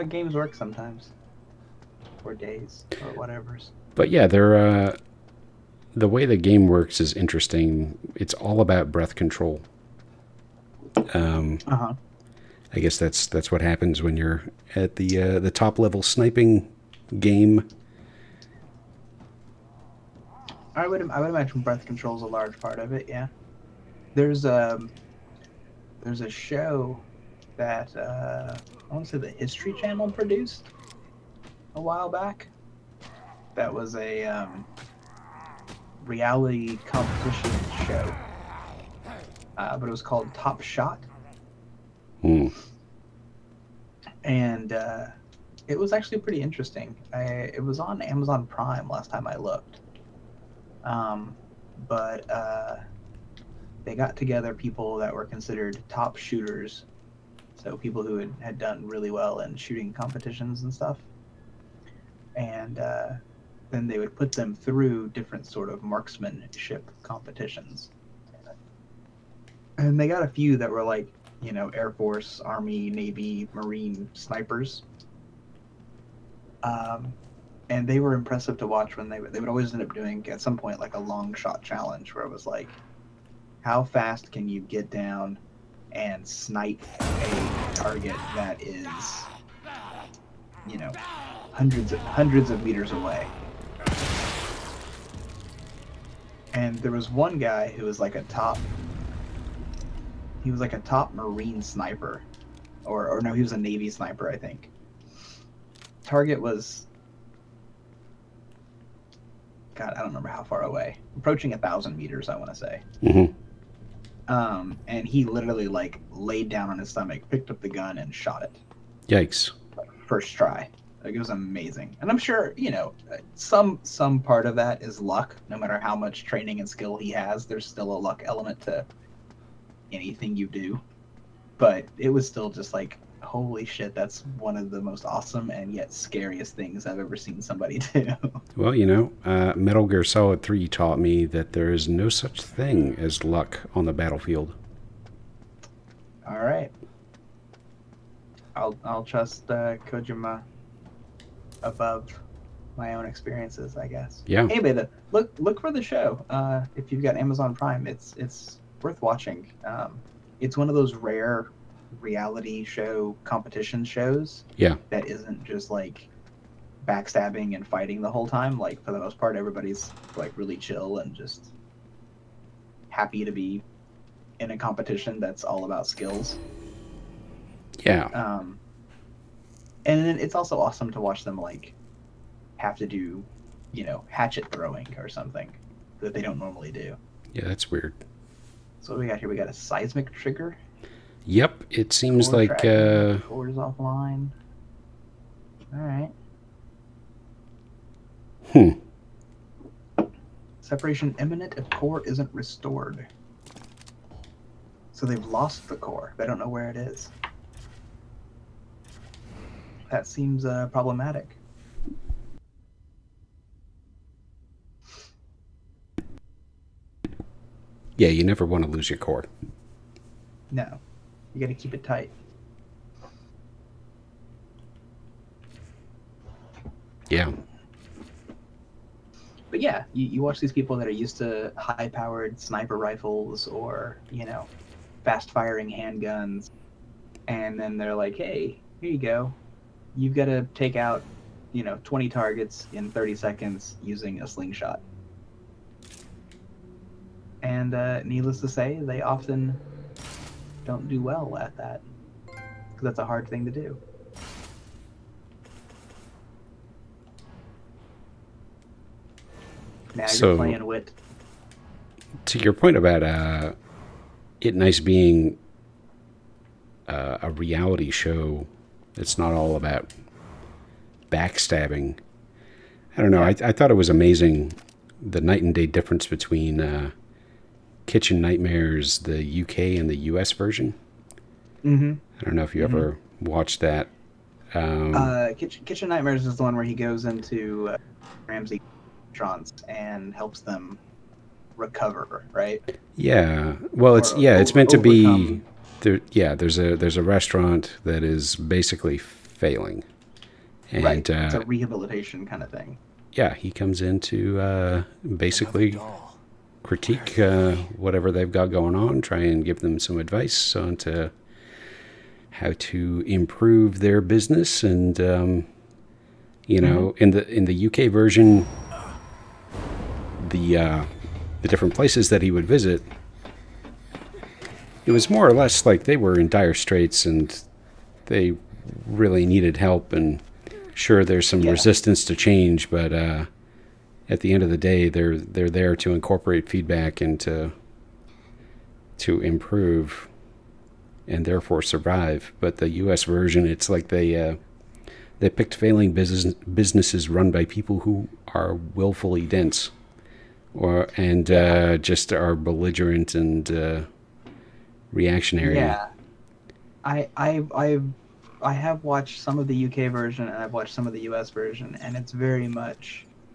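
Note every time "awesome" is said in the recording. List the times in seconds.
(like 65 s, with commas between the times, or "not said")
135 s, 180 s.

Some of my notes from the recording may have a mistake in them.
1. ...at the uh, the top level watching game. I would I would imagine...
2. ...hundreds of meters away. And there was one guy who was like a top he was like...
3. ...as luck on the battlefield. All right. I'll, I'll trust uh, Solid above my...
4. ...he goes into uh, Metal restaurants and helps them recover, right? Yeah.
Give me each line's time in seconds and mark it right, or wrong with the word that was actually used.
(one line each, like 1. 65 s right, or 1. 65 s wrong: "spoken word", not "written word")
1. 14 s wrong: "sniping", not "watching"
2. 91 s right
3. 142 s wrong: "Kojima", not "Solid"
4. 286 s wrong: "Ramsey", not "Metal".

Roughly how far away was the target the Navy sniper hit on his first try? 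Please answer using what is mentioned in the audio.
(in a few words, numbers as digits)
1000 meters.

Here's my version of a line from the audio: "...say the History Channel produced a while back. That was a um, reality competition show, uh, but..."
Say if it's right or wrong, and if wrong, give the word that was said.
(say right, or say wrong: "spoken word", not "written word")
right.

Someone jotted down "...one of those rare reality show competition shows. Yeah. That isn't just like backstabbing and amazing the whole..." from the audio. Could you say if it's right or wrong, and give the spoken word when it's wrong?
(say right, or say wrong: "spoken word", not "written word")
wrong: "fighting", not "amazing".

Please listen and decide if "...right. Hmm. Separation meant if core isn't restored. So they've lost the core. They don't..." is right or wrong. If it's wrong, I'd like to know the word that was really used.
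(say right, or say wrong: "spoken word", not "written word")
wrong: "imminent", not "meant".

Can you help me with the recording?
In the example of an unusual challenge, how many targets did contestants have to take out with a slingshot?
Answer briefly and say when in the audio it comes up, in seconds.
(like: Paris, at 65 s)
20, at 241 s.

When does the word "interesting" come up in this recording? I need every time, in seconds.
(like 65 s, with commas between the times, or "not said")
7 s, 46 s.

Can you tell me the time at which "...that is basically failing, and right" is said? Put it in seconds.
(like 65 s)
297 s.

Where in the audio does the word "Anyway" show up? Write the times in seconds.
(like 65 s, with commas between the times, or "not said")
154 s.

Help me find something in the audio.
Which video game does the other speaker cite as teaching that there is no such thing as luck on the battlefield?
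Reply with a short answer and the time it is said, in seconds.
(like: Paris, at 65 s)
Metal Gear Solid 3, at 139 s.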